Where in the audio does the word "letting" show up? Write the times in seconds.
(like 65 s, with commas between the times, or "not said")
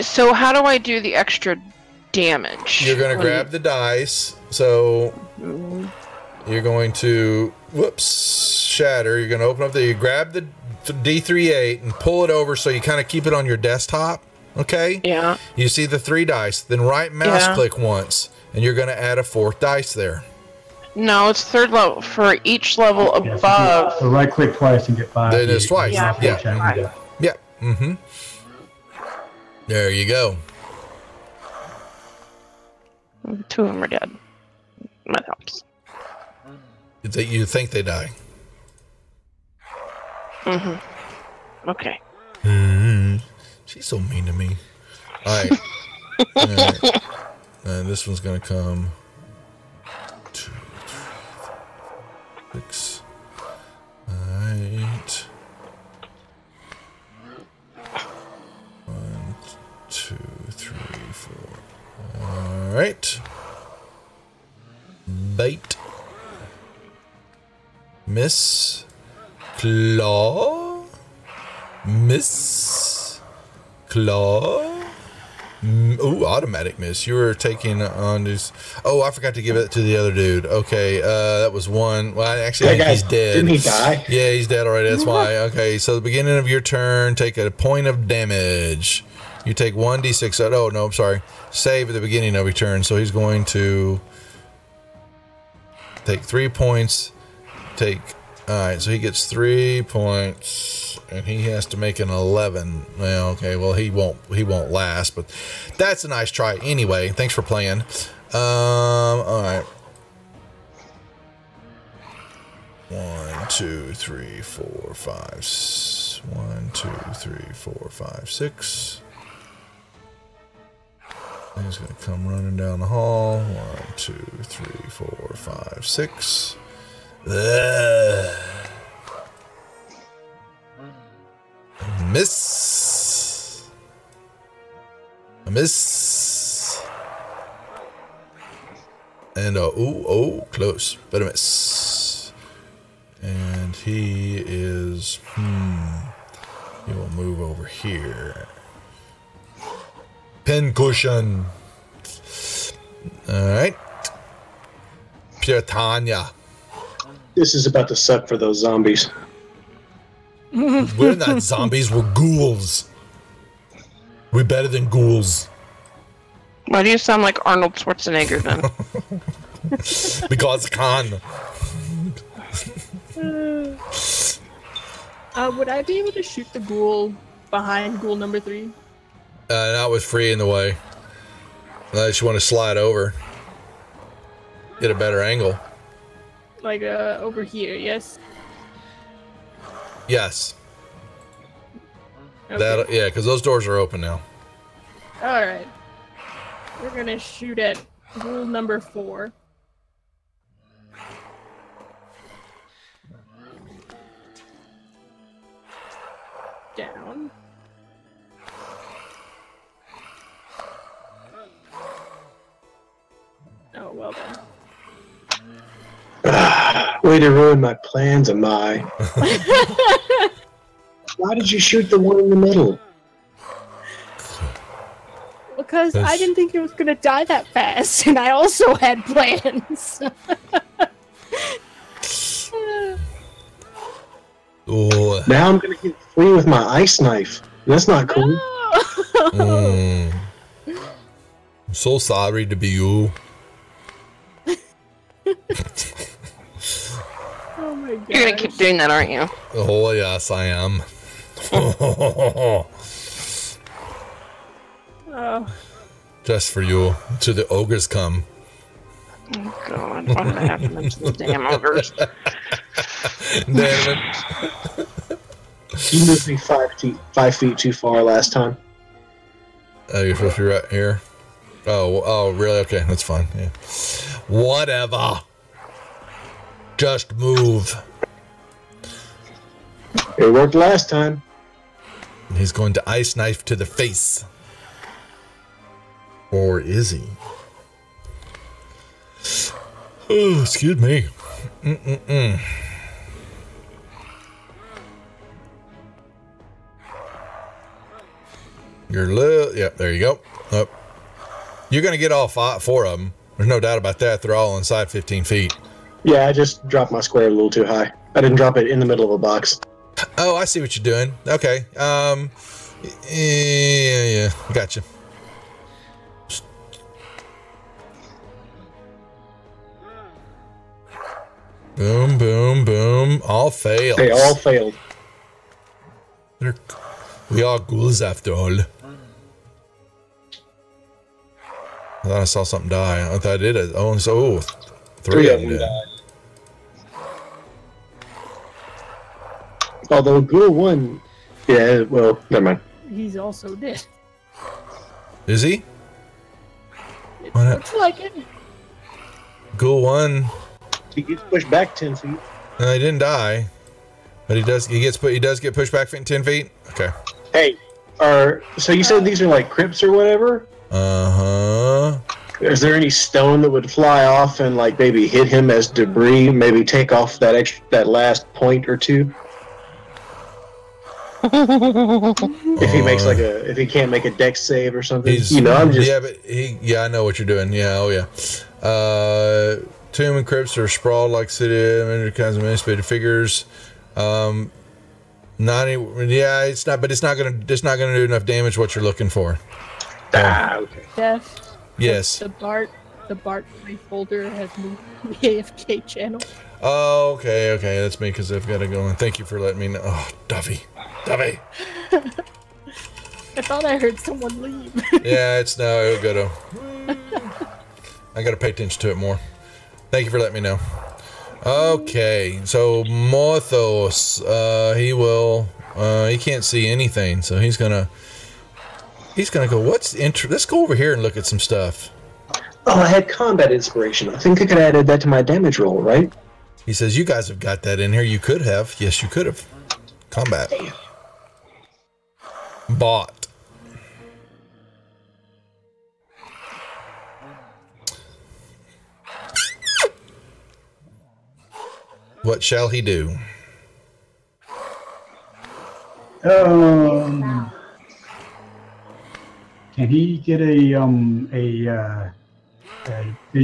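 399 s, 410 s.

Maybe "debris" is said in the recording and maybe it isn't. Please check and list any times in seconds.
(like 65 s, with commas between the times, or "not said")
365 s.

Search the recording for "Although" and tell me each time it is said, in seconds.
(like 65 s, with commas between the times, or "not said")
339 s.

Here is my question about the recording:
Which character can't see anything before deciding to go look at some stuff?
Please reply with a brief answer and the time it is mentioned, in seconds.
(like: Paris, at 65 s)
Morthos, at 412 s.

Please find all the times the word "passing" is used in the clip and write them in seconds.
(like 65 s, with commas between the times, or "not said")
not said.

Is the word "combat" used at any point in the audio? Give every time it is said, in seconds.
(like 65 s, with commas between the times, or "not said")
423 s, 430 s.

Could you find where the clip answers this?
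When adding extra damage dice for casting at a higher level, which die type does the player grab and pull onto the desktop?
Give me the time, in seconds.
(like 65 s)
10 s.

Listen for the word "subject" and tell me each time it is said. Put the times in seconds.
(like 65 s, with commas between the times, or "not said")
not said.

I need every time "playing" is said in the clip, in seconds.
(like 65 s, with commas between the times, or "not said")
107 s.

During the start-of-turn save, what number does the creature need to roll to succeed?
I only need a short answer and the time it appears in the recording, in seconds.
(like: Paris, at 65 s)
11, at 102 s.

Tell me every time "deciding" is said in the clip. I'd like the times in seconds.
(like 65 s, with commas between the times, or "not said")
not said.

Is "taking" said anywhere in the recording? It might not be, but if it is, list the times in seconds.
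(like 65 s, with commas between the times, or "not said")
77 s.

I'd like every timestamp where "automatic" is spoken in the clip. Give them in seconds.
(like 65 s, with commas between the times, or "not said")
76 s.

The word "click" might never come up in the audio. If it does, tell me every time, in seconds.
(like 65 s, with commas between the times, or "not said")
17 s, 24 s.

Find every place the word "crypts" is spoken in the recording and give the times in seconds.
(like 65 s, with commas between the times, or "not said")
359 s, 380 s.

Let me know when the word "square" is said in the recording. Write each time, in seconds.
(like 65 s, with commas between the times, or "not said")
307 s.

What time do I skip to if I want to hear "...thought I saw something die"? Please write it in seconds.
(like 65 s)
332 s.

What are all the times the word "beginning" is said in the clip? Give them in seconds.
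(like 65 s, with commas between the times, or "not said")
86 s, 91 s.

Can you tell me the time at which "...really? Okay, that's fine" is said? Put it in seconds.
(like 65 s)
272 s.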